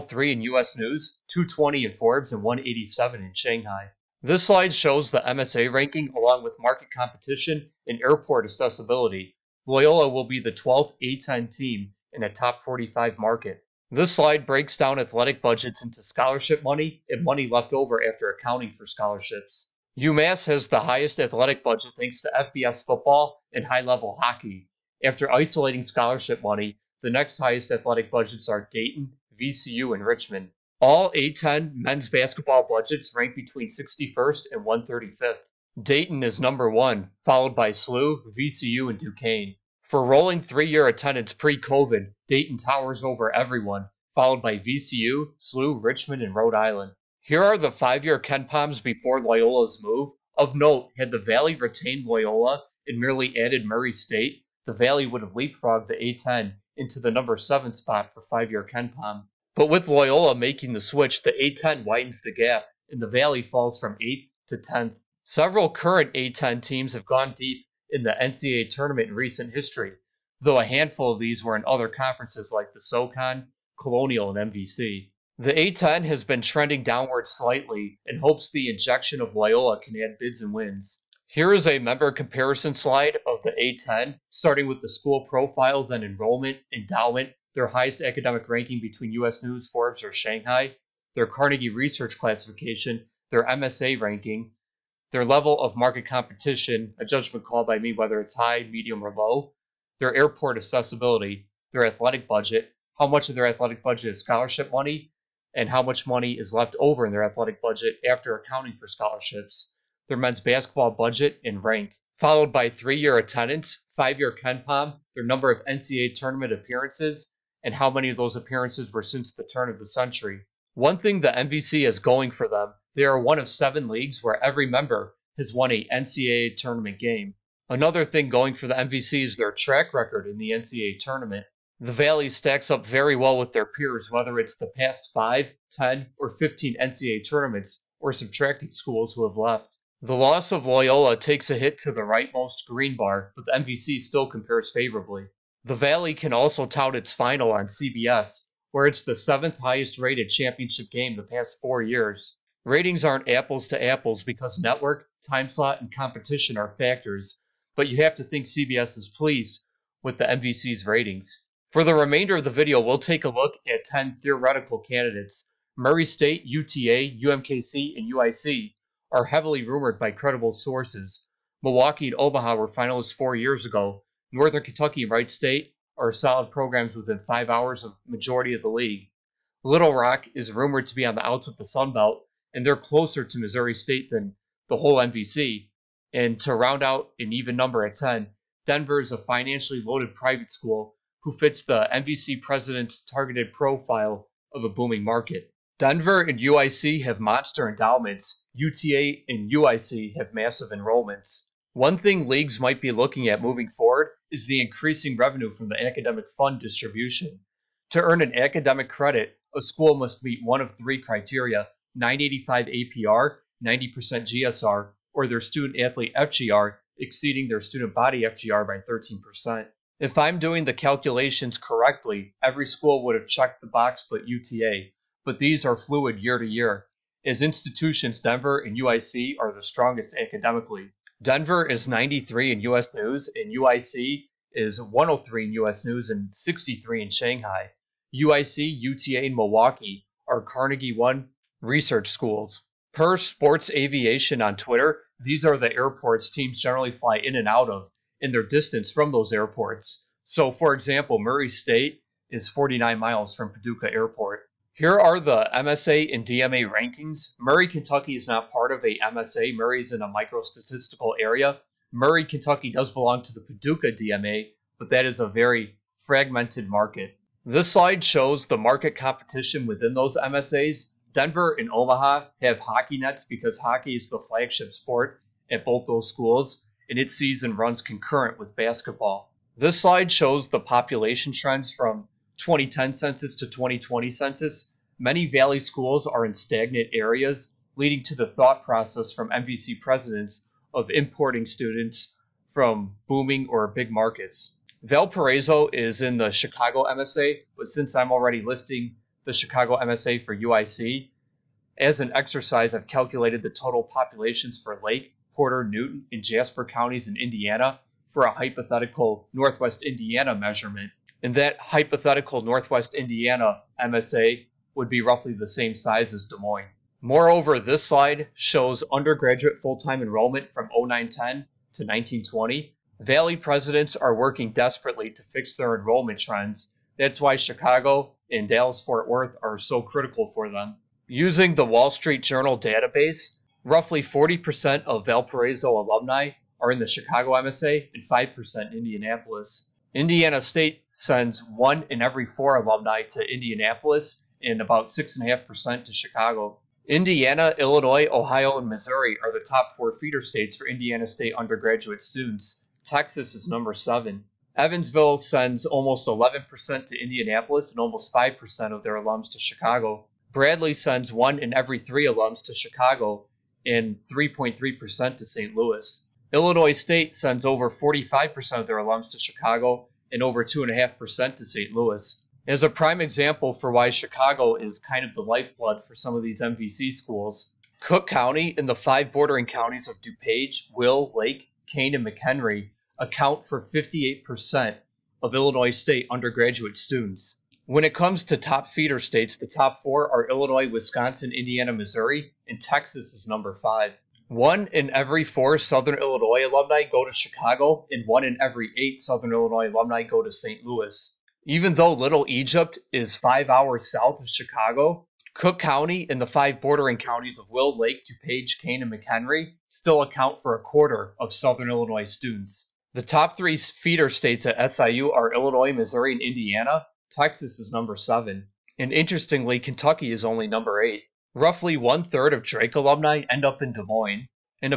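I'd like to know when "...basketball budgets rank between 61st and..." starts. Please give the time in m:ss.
0:32.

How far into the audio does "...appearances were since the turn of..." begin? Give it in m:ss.
1:58.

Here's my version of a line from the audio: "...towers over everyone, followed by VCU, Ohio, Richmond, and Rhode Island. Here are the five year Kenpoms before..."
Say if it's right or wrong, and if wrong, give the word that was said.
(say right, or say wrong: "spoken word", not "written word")
wrong: "SLU", not "Ohio".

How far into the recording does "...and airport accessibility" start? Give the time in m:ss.
0:07.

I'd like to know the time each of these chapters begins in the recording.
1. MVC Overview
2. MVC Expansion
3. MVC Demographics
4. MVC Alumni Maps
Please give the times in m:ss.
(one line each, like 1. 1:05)
1. 2:00
2. 2:41
3. 4:14
4. 5:31.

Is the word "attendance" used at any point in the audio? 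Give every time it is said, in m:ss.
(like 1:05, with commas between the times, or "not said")
0:40, 1:53.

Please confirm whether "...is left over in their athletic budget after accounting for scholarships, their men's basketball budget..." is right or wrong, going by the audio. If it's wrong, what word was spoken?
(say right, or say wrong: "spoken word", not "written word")
right.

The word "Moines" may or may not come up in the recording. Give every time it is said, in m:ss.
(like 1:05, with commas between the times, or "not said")
5:16, 7:03.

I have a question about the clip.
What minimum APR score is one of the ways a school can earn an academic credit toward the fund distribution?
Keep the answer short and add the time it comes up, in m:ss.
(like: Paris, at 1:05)
985, at 3:31.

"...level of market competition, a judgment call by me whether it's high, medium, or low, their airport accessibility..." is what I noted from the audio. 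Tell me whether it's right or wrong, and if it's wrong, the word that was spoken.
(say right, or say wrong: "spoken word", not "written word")
right.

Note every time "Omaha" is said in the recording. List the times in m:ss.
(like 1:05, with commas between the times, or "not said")
2:52, 4:31.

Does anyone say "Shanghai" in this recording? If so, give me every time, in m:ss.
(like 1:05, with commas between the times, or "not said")
0:03, 1:30, 3:57.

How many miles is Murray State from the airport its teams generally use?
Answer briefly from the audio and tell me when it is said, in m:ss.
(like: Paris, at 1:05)
49, at 4:12.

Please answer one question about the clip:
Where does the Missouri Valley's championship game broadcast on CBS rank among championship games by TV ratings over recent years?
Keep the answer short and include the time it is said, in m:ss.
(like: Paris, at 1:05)
7th, at 2:29.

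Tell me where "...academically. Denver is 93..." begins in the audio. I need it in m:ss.
3:50.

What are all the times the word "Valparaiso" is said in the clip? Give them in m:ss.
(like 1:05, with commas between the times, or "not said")
4:54, 5:35.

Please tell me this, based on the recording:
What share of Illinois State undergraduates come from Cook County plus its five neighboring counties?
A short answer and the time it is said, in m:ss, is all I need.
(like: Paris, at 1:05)
58%, at 6:23.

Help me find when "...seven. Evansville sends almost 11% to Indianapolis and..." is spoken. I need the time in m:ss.
5:53.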